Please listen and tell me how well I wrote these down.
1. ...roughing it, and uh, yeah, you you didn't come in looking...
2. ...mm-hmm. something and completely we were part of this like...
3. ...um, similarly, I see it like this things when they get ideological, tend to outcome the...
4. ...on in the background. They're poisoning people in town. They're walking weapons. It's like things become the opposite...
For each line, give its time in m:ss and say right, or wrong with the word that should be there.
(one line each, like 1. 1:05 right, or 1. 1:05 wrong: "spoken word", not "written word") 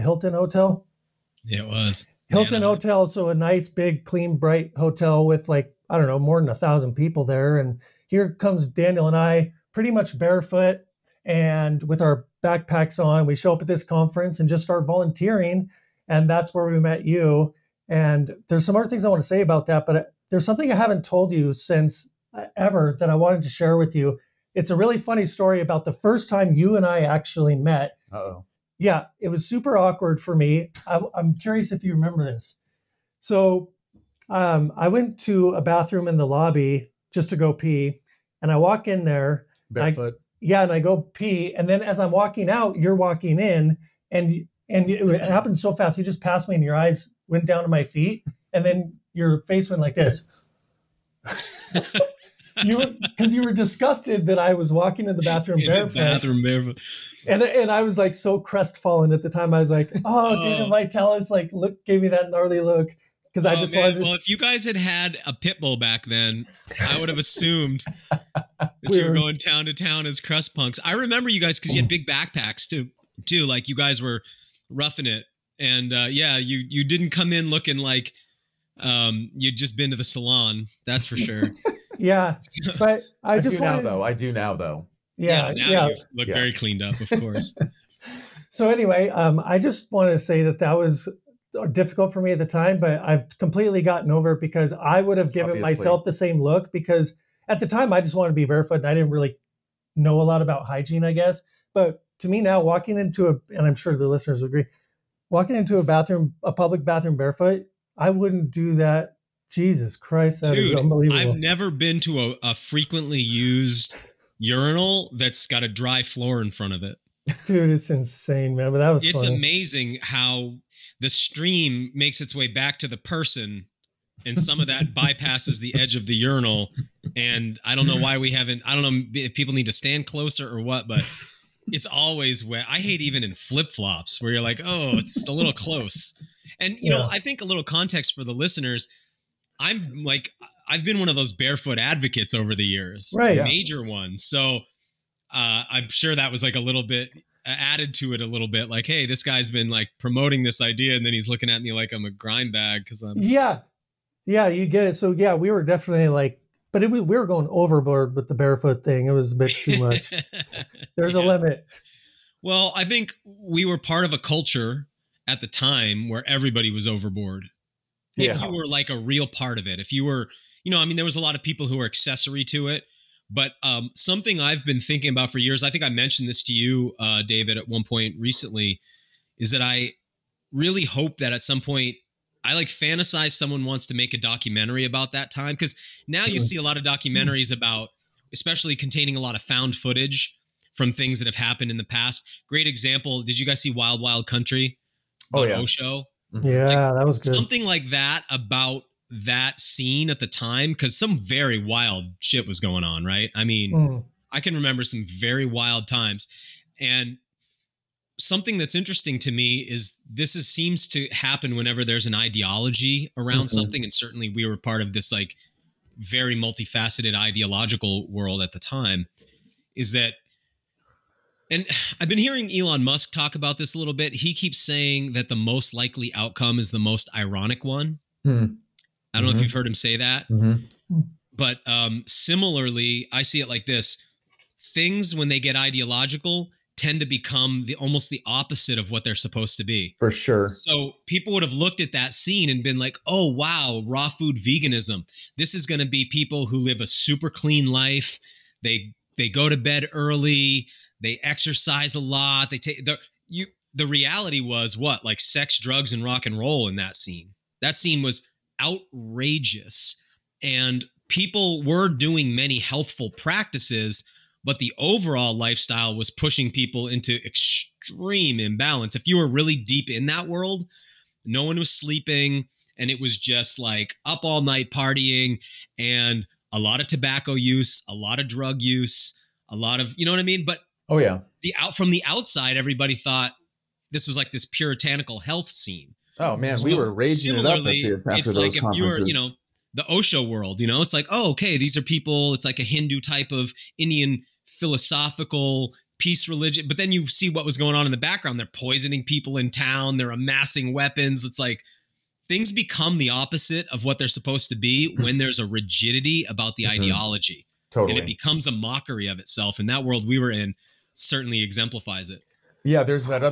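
1. 1:14 right
2. 3:33 wrong: "certainly", not "completely"
3. 3:51 wrong: "become", not "outcome"
4. 4:57 wrong: "amassing", not "walking".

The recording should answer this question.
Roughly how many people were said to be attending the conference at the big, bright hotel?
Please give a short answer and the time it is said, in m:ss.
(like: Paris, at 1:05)
more than a thousand, at 0:06.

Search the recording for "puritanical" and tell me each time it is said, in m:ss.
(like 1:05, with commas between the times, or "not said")
4:44.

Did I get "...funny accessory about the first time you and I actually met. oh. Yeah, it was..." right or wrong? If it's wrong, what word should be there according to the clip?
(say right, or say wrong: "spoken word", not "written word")
wrong: "story", not "accessory".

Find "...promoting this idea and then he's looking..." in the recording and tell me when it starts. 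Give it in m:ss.
2:29.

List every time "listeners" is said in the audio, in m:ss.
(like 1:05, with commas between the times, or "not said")
1:44, 2:18.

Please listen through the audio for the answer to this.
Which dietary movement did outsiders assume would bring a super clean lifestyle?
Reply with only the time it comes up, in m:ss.
4:03.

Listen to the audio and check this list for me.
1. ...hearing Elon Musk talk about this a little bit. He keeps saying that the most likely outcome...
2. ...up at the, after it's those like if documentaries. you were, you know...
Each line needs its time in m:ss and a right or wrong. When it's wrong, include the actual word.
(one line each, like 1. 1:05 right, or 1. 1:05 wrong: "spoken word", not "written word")
1. 3:42 right
2. 4:47 wrong: "conferences", not "documentaries".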